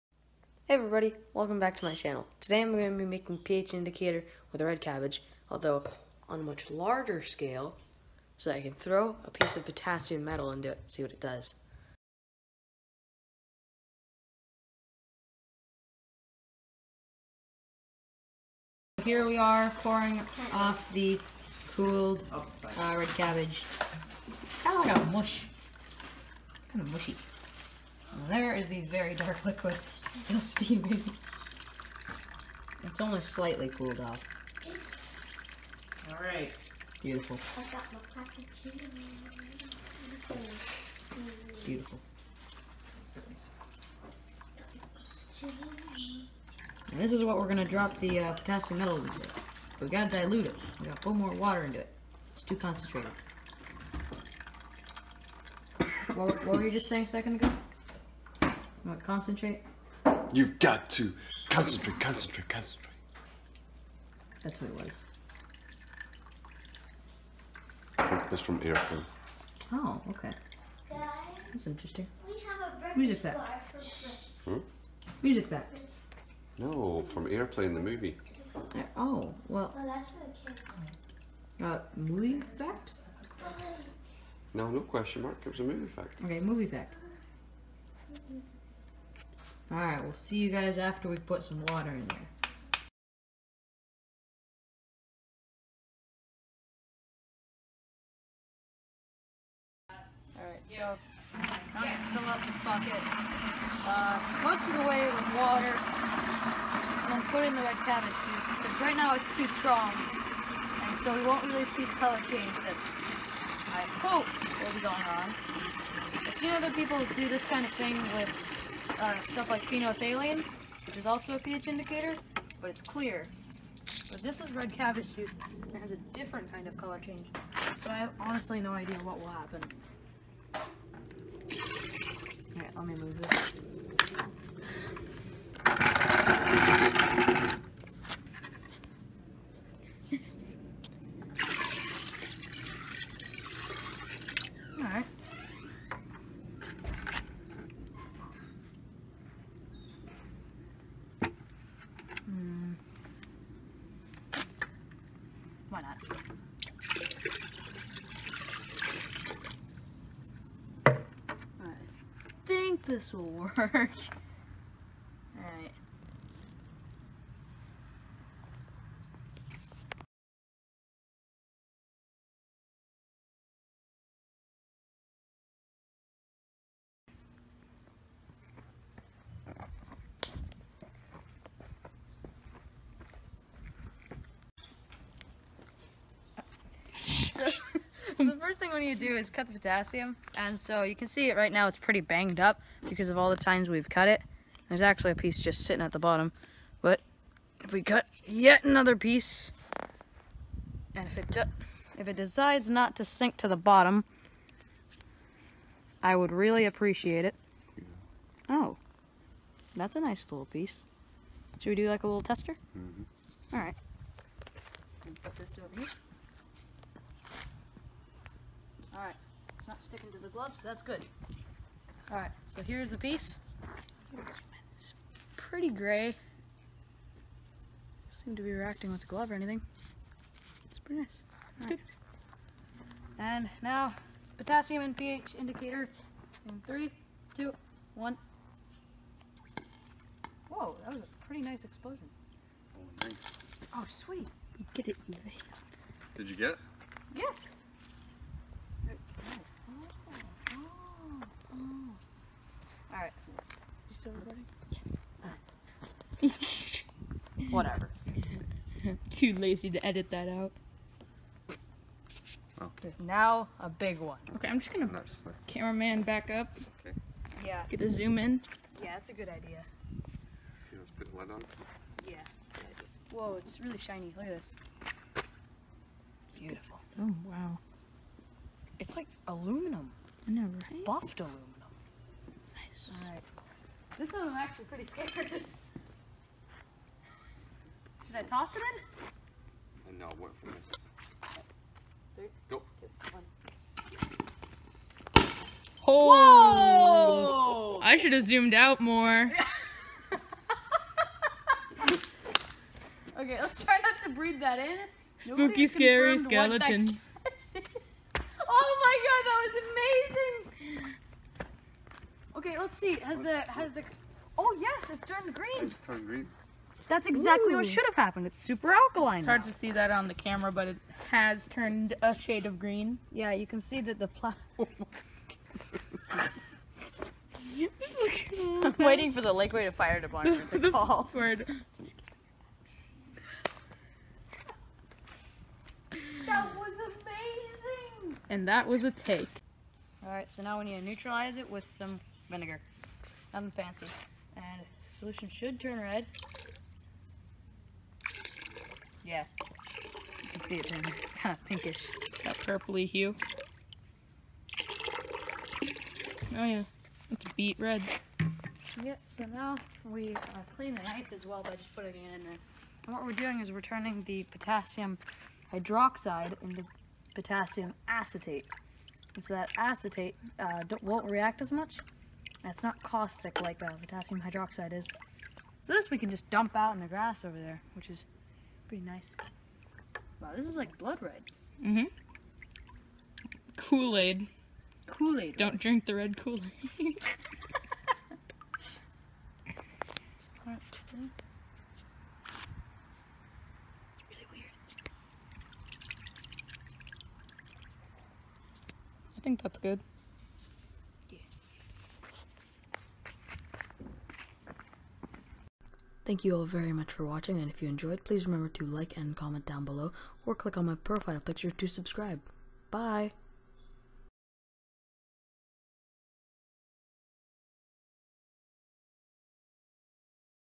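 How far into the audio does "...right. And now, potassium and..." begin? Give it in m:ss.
3:51.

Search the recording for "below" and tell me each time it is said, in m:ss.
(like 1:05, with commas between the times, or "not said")
6:49.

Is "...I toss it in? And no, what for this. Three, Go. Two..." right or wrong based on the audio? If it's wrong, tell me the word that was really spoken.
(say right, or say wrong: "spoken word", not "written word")
right.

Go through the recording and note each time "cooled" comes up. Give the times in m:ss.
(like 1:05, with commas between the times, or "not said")
0:21, 0:33.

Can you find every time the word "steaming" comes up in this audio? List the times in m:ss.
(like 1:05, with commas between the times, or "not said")
0:30.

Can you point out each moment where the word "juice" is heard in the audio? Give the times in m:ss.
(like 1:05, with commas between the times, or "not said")
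1:48, 2:05.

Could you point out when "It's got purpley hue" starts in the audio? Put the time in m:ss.
5:52.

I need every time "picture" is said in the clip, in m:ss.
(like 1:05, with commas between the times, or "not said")
6:51.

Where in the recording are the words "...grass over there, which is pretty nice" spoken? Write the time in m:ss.
6:16.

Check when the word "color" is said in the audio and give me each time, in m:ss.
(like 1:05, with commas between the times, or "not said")
1:51, 2:06.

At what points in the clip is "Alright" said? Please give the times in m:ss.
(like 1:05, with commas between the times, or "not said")
0:36, 1:29, 1:40, 2:12, 4:43, 5:40.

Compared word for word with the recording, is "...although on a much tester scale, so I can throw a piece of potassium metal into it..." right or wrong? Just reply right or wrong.
wrong.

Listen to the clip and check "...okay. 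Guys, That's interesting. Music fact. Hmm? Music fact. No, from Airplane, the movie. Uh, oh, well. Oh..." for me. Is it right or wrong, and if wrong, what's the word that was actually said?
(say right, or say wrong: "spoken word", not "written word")
right.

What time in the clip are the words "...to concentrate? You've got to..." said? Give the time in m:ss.
0:58.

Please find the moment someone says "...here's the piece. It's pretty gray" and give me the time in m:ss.
3:42.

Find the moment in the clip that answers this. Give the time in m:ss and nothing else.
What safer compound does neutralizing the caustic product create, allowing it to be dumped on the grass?
6:07.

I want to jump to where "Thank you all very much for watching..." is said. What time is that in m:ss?
6:46.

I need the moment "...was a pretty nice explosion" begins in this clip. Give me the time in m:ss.
4:00.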